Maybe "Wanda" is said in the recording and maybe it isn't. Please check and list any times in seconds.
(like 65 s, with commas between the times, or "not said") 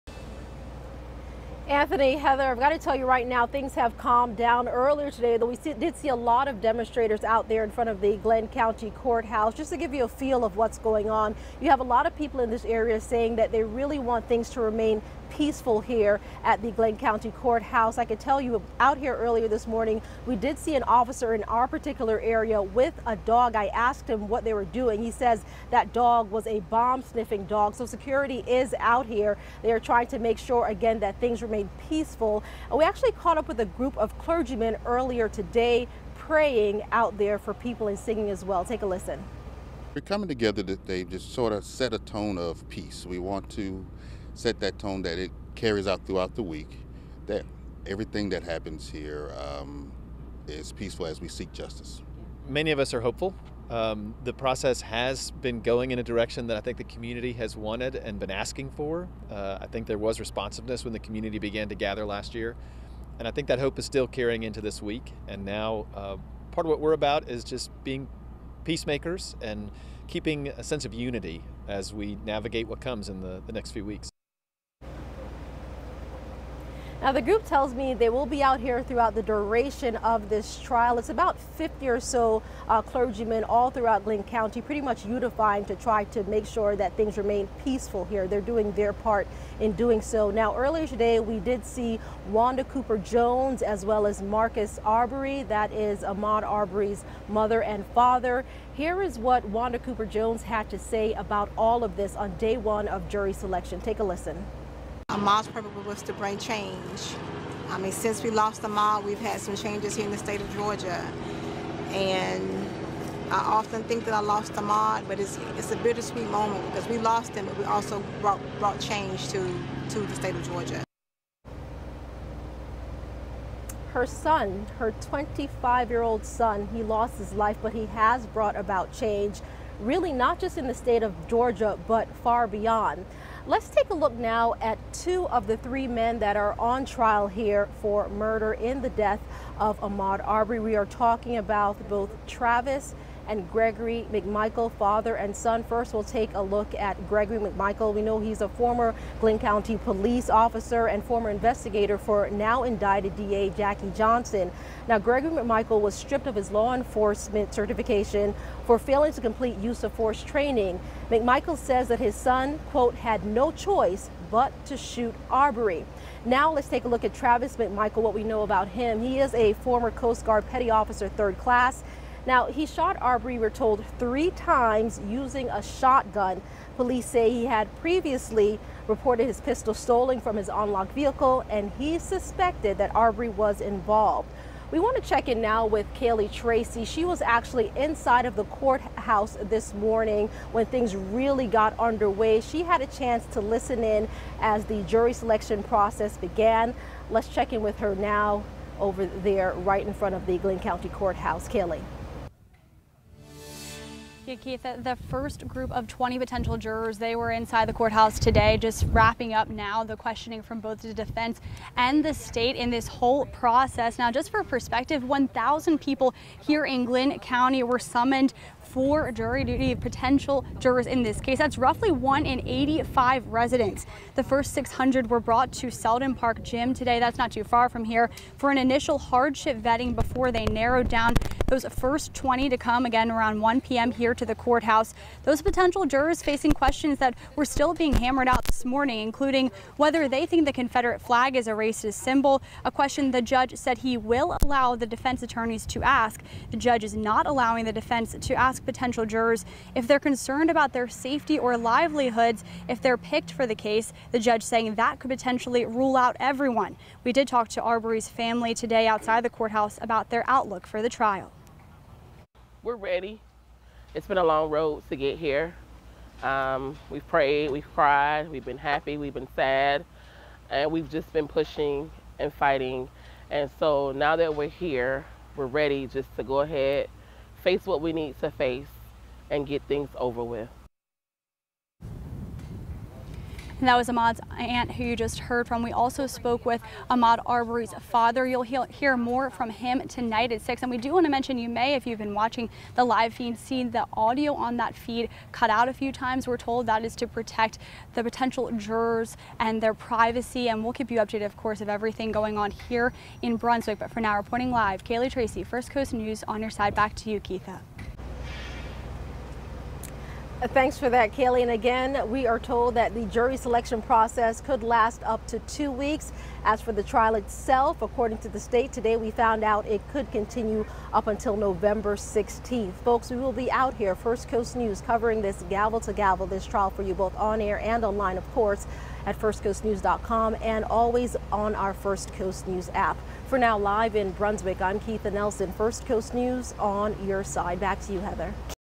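92 s, 99 s.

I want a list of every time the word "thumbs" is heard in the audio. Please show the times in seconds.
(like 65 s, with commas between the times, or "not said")
not said.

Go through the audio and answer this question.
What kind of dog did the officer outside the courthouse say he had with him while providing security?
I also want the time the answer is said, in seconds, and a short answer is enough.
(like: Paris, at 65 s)
bomb sniffing dog, at 26 s.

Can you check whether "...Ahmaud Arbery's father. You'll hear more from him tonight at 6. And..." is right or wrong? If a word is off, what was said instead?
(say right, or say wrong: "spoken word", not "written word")
right.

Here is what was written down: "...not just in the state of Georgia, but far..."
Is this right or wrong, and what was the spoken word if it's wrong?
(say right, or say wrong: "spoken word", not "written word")
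right.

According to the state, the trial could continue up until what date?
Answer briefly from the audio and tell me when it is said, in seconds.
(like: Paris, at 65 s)
November 16th, at 321 s.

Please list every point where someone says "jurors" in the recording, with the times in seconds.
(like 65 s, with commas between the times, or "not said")
206 s, 220 s, 235 s, 249 s, 298 s.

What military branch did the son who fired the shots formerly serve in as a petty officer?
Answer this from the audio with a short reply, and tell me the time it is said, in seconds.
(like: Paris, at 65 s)
Coast Guard, at 169 s.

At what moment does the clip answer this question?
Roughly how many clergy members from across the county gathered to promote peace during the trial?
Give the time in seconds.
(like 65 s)
81 s.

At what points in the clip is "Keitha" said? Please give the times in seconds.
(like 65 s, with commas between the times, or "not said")
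204 s, 307 s, 334 s.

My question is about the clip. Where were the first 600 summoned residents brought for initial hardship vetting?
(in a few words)
Selden Park Gym.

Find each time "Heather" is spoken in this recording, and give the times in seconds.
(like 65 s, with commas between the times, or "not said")
2 s, 337 s.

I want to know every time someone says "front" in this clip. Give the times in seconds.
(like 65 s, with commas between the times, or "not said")
7 s, 199 s.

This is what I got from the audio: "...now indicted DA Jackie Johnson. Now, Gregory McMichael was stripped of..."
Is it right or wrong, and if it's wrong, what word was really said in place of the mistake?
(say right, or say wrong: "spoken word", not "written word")
right.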